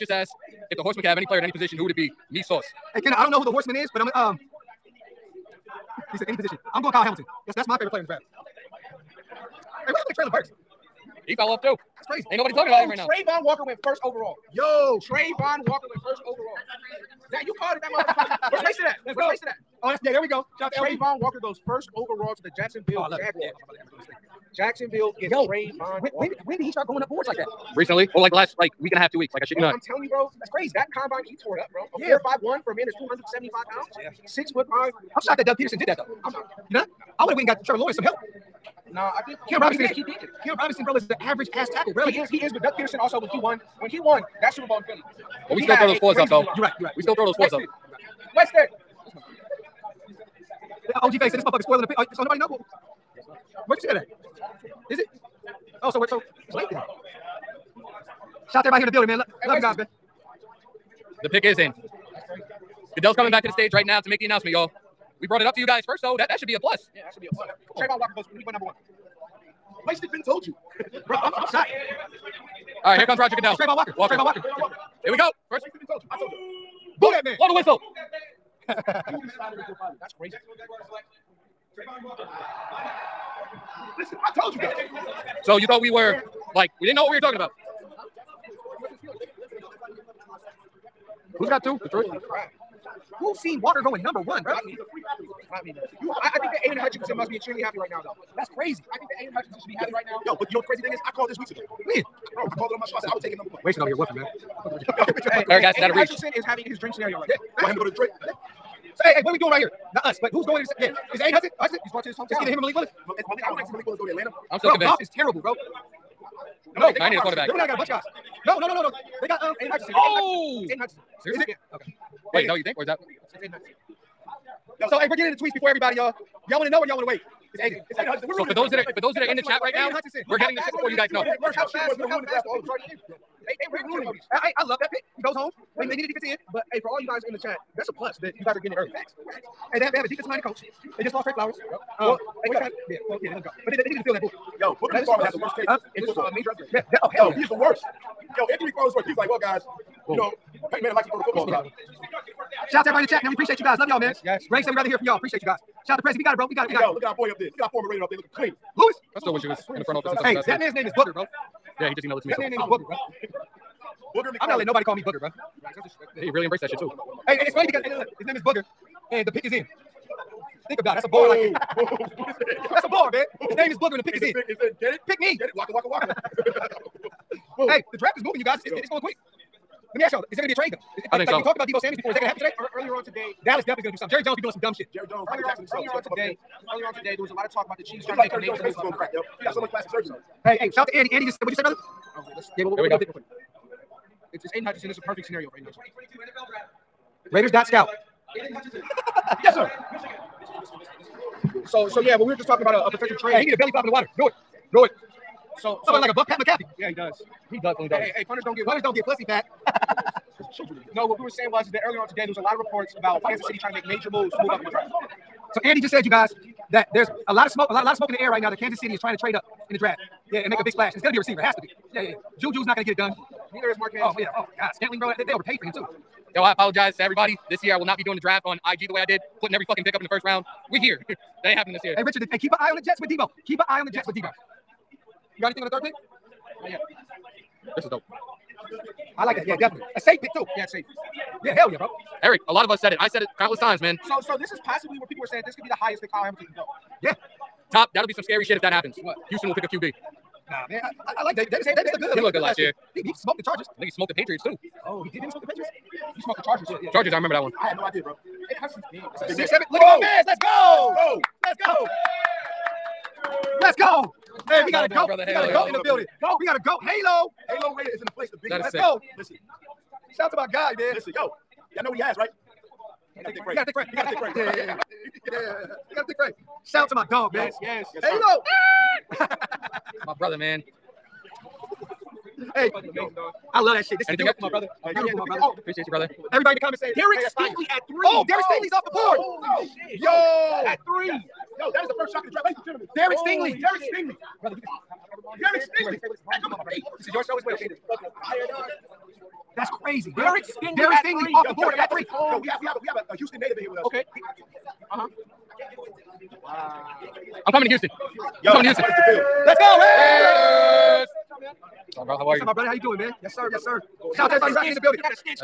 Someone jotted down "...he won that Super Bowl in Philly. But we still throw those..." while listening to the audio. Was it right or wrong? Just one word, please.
right.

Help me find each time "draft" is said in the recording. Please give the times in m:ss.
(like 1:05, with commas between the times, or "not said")
0:08, 2:57, 3:34, 3:39, 3:48, 4:52.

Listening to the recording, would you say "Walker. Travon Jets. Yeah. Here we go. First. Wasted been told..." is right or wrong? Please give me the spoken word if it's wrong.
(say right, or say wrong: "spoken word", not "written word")
wrong: "Walker", not "Jets".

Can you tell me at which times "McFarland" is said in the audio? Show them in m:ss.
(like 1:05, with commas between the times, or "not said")
2:28, 2:44.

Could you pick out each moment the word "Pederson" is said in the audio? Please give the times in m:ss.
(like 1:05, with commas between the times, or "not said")
0:35, 0:42.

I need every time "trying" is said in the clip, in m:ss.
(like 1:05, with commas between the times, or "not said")
3:08, 3:33, 3:38.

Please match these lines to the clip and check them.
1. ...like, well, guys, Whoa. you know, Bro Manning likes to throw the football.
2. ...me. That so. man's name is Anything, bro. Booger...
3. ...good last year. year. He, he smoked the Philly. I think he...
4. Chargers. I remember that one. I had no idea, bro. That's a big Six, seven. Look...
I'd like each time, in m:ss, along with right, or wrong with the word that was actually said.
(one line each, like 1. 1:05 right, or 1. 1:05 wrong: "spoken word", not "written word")
1. 2:29 wrong: "Peyton", not "Bro"
2. 2:42 wrong: "Booger", not "Anything"
3. 4:12 wrong: "Chargers", not "Philly"
4. 4:16 right.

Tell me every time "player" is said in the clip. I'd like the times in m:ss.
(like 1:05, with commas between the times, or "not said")
0:01, 0:07.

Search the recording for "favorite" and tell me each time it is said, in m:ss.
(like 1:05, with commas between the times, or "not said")
0:07.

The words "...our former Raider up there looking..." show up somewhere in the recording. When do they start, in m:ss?
2:37.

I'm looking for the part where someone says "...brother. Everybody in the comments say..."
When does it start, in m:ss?
4:45.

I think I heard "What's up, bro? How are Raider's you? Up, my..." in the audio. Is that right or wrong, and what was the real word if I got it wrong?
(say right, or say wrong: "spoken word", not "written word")
wrong: "What", not "Raider".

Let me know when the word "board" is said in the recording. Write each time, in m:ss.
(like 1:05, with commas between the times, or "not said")
0:27, 4:48, 5:01.